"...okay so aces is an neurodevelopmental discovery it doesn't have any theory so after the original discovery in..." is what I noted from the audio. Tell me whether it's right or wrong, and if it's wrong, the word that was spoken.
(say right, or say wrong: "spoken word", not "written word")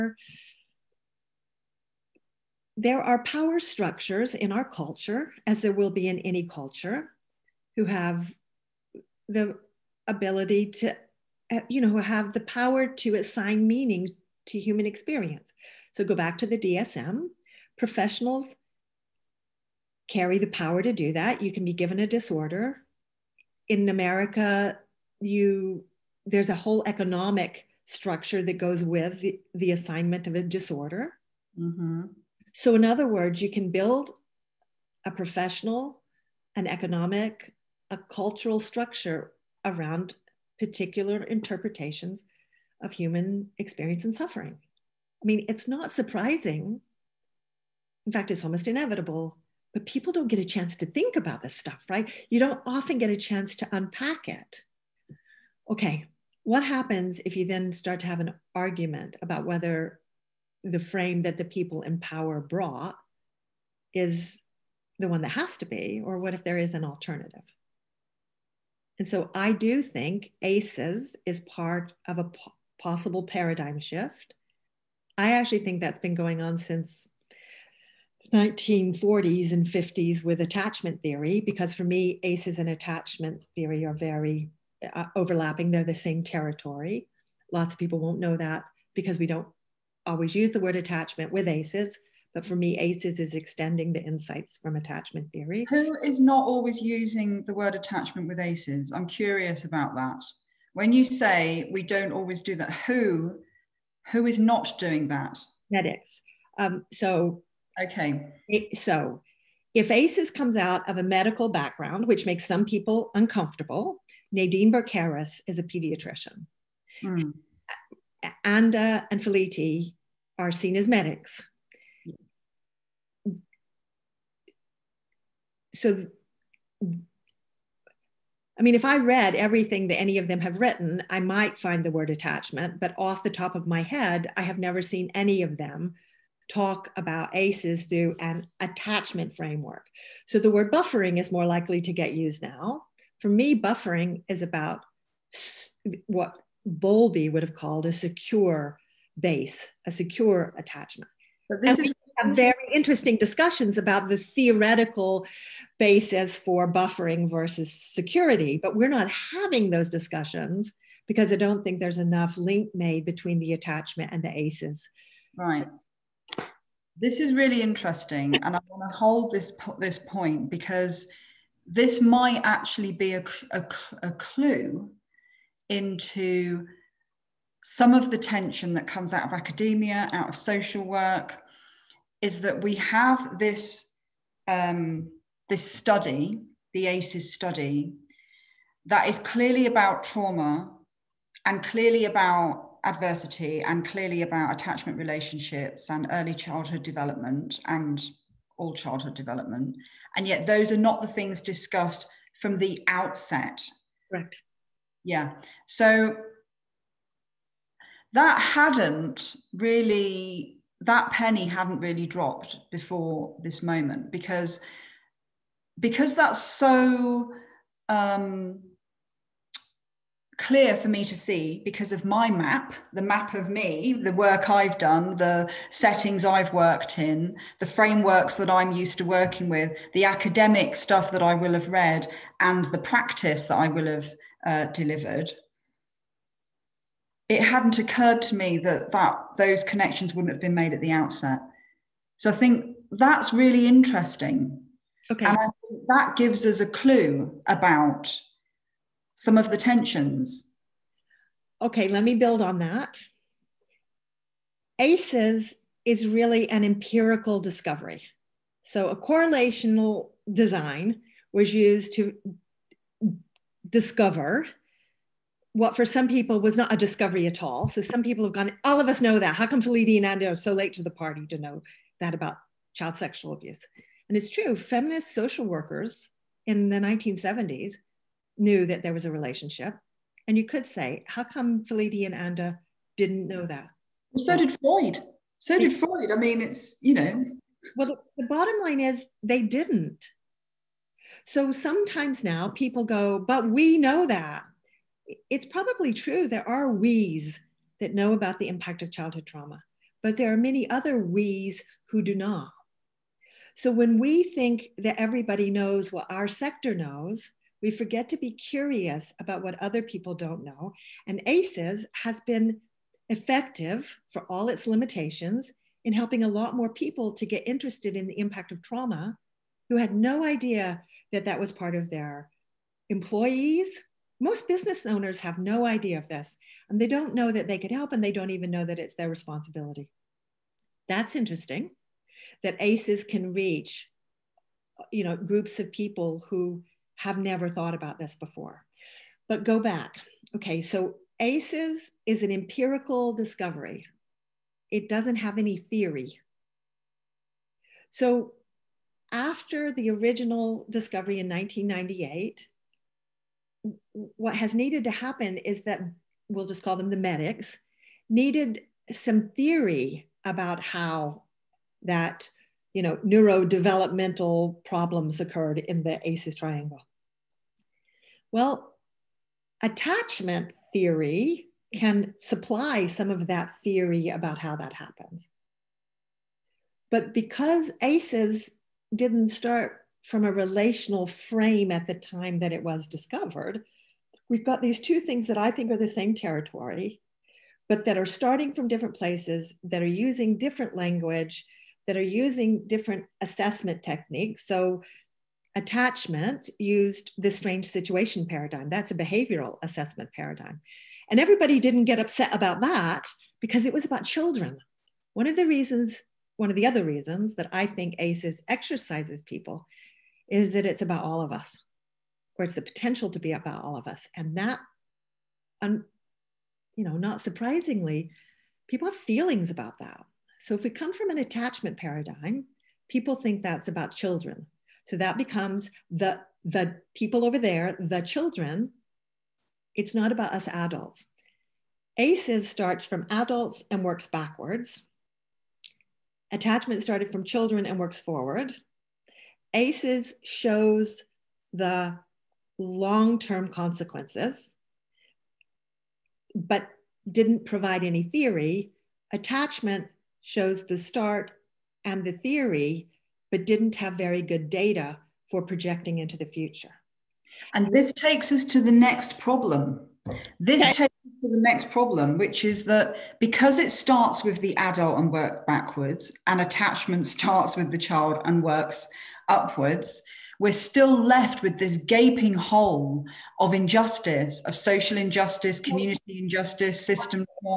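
wrong: "empirical", not "neurodevelopmental".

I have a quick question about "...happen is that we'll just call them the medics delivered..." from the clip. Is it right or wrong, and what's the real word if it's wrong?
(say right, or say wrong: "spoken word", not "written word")
wrong: "needed", not "delivered".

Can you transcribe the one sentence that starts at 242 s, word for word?
So I think that's really interesting.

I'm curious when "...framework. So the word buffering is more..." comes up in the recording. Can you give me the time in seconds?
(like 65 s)
139 s.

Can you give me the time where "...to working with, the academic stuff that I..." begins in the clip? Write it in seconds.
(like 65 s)
228 s.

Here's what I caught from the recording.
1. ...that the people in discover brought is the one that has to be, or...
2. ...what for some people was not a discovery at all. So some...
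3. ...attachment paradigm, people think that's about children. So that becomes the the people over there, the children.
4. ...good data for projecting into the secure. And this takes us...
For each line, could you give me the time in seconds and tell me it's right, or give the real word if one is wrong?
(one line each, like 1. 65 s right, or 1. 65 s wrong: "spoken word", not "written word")
1. 61 s wrong: "power", not "discover"
2. 265 s right
3. 421 s right
4. 454 s wrong: "future", not "secure".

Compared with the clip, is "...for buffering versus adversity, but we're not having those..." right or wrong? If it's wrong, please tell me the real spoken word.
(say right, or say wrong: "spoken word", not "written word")
wrong: "security", not "adversity".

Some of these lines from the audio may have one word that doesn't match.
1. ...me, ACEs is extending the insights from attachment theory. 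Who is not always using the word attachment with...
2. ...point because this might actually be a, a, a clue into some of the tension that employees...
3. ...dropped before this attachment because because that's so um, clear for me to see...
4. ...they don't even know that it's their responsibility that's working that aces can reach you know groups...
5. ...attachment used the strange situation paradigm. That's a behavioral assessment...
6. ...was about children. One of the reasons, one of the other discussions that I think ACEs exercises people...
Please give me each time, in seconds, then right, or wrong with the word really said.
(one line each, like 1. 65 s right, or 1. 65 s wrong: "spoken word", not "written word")
1. 92 s right
2. 169 s wrong: "comes", not "employees"
3. 212 s wrong: "moment", not "attachment"
4. 328 s wrong: "interesting", not "working"
5. 395 s right
6. 403 s wrong: "reasons", not "discussions".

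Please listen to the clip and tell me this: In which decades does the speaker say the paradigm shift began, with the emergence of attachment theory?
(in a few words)
1940s and 50s.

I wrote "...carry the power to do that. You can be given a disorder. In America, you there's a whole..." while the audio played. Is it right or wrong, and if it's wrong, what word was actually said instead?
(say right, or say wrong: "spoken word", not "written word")
right.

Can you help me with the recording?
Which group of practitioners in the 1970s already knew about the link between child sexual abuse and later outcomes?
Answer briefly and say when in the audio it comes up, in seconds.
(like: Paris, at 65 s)
Feminist social workers, at 274 s.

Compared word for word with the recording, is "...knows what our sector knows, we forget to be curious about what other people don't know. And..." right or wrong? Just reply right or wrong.
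right.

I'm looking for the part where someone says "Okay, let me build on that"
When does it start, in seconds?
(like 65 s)
251 s.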